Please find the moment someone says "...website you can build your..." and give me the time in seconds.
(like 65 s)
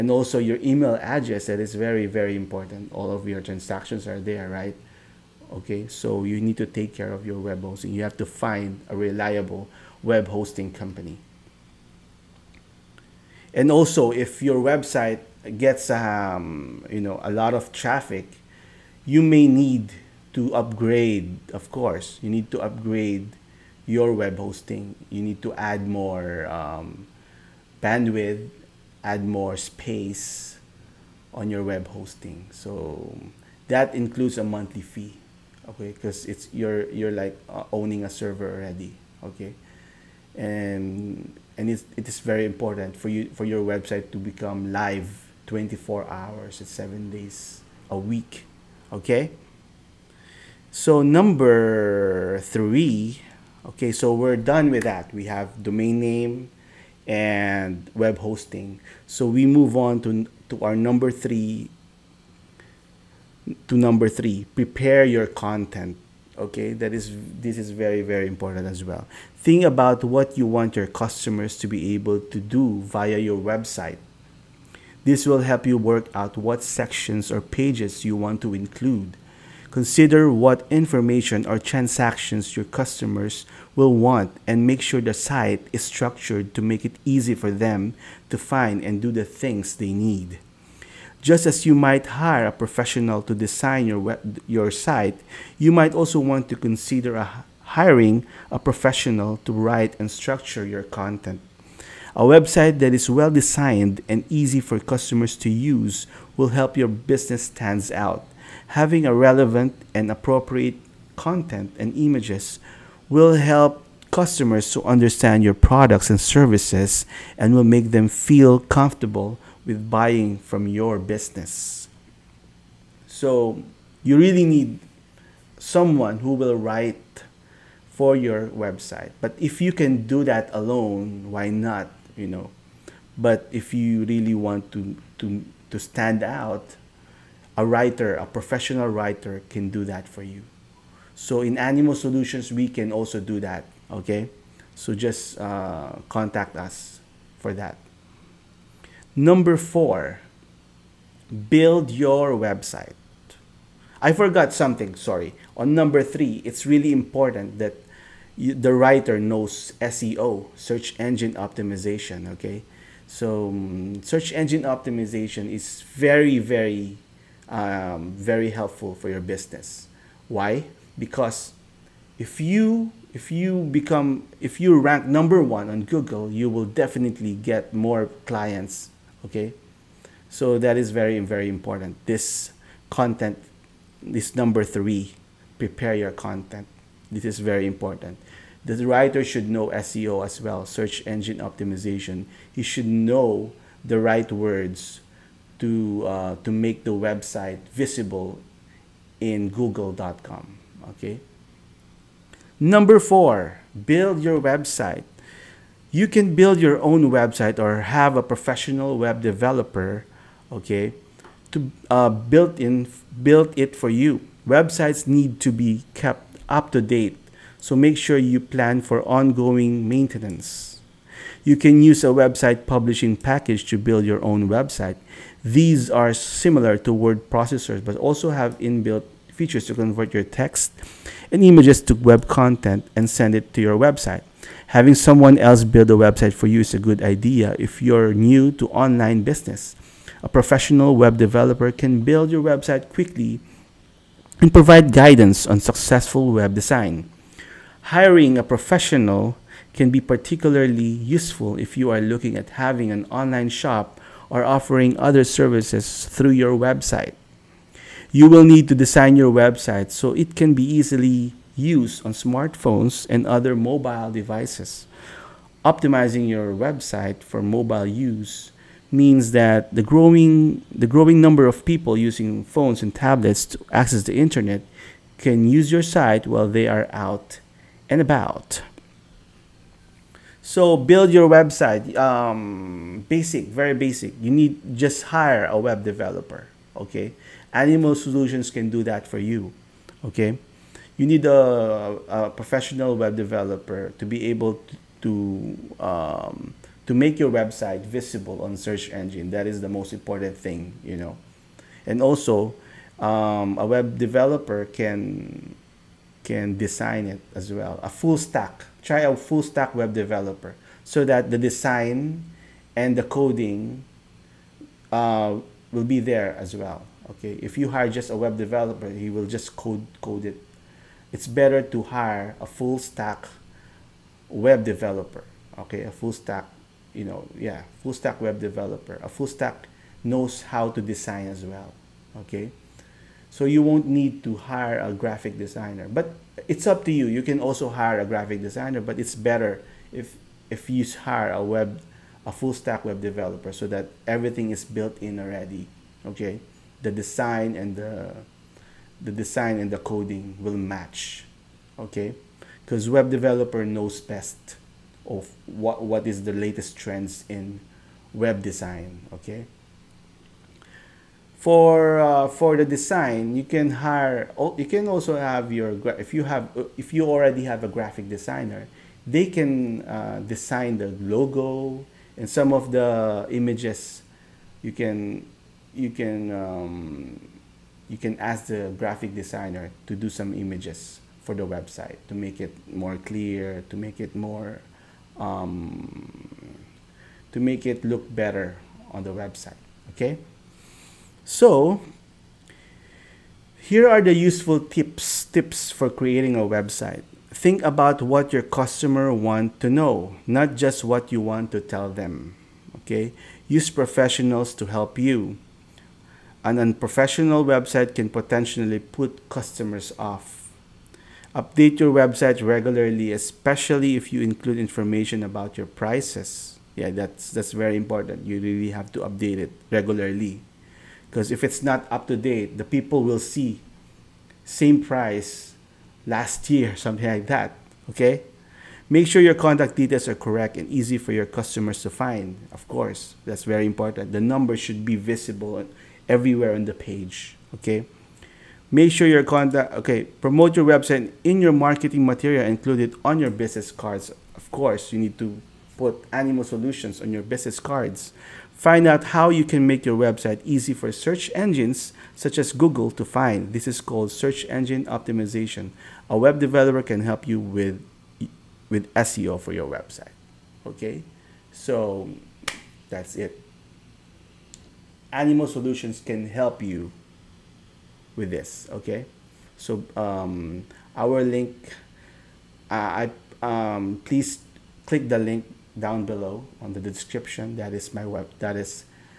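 204 s.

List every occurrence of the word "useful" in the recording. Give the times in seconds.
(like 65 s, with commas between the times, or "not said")
250 s, 394 s.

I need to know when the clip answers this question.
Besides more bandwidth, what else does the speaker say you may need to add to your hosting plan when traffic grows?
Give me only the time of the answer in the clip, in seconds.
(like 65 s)
29 s.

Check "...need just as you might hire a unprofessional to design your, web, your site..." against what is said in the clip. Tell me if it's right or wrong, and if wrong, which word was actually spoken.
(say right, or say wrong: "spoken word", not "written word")
wrong: "professional", not "unprofessional".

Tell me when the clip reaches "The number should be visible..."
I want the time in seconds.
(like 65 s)
434 s.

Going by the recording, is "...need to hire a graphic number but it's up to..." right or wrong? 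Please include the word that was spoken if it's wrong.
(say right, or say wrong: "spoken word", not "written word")
wrong: "designer", not "number".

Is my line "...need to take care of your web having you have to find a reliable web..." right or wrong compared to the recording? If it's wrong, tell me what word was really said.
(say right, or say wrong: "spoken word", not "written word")
wrong: "hosting", not "having".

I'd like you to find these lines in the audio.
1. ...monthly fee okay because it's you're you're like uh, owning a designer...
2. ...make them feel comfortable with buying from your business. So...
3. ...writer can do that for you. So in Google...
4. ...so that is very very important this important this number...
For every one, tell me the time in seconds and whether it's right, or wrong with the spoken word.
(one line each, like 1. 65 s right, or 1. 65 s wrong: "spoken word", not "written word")
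1. 34 s wrong: "server", not "designer"
2. 117 s right
3. 138 s wrong: "Animo", not "Google"
4. 180 s wrong: "content", not "important".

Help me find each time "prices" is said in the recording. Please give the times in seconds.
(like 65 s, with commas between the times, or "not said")
415 s, 424 s.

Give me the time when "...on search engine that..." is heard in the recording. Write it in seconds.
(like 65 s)
298 s.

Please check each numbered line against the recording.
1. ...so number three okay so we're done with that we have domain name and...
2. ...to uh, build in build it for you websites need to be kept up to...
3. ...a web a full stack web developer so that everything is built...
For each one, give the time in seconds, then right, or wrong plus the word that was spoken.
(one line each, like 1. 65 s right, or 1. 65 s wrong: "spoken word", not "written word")
1. 50 s right
2. 211 s right
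3. 341 s right.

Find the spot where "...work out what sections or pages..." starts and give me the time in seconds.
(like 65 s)
75 s.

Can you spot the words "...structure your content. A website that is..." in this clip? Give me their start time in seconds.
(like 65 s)
100 s.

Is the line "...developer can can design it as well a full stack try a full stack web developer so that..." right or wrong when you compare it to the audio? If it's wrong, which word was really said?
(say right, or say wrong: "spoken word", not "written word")
right.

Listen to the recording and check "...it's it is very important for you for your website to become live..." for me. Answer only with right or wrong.
right.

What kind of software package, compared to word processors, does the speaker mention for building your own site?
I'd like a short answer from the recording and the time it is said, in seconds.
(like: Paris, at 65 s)
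website publishing package, at 222 s.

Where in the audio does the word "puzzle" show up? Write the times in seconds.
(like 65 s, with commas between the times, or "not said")
not said.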